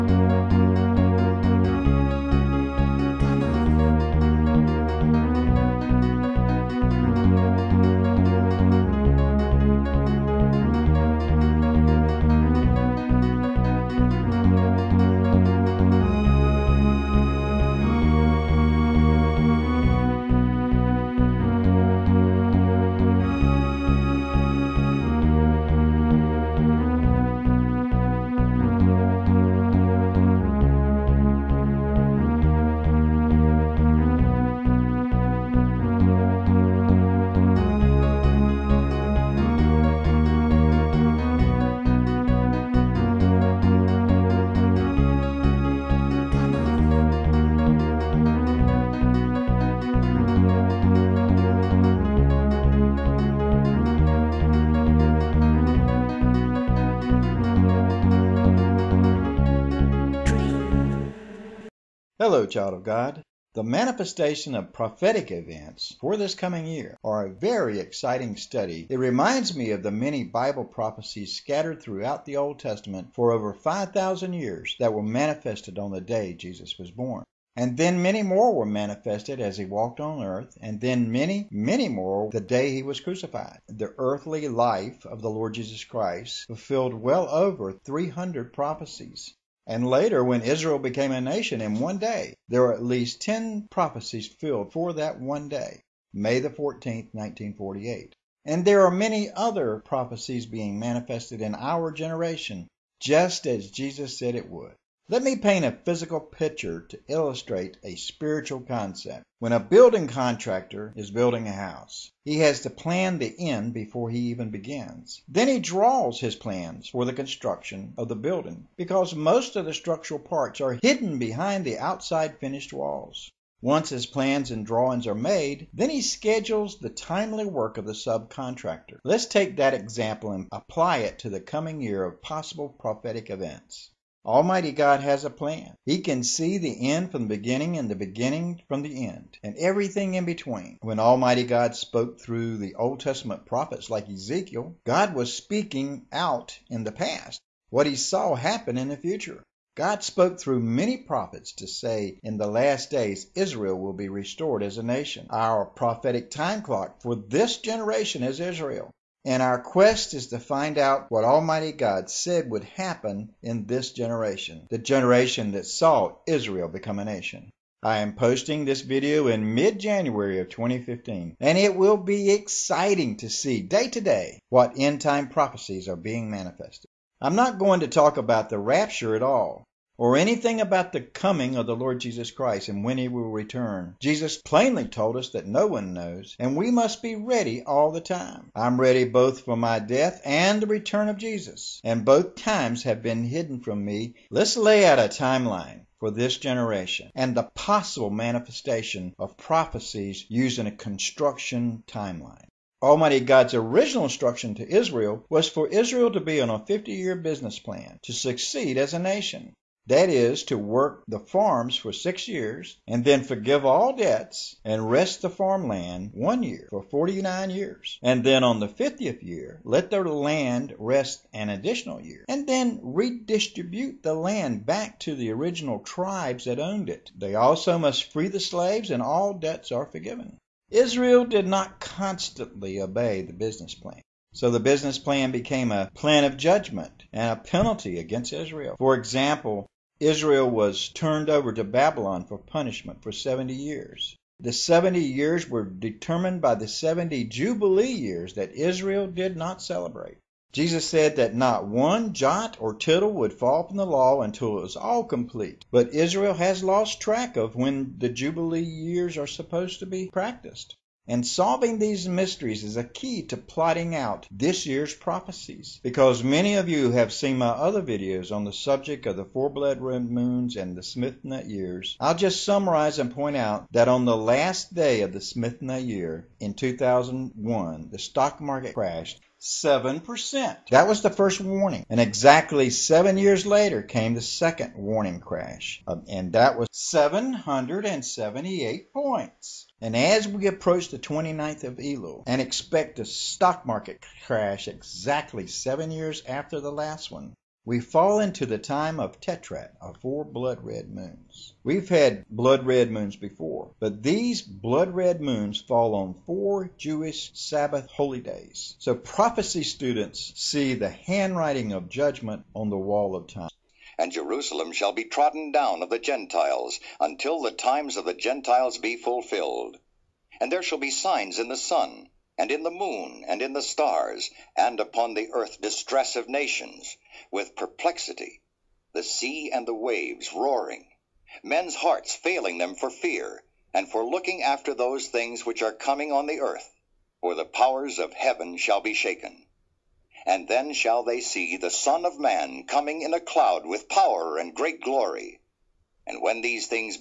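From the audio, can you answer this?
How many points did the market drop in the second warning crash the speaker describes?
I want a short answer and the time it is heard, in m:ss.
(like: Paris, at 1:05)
778, at 4:46.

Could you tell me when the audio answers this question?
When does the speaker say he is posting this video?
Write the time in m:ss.
2:49.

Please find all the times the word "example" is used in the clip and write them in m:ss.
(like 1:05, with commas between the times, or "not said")
2:09, 3:58.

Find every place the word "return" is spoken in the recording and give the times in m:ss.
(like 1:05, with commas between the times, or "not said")
3:03, 3:10.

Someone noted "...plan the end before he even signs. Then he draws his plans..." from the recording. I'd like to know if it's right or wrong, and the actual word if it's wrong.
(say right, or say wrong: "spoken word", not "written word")
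wrong: "begins", not "signs".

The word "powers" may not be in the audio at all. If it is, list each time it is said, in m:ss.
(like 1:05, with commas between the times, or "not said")
5:37, 5:43.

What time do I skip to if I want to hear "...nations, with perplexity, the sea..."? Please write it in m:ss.
5:26.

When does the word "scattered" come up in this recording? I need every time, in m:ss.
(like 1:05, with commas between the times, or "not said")
1:11.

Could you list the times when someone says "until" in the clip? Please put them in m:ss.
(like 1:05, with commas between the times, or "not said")
4:14, 5:17.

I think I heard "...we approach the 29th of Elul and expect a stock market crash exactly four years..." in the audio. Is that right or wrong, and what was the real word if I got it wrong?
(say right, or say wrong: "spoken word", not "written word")
wrong: "seven", not "four".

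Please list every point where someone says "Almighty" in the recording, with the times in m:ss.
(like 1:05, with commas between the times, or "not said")
2:14, 2:20, 2:41, 3:22.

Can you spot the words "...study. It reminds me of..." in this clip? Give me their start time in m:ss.
1:08.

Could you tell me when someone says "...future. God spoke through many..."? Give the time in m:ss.
2:28.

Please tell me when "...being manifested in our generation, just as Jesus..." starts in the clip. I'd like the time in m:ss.
1:40.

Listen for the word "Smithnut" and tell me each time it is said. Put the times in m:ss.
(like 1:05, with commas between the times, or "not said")
4:30, 4:35.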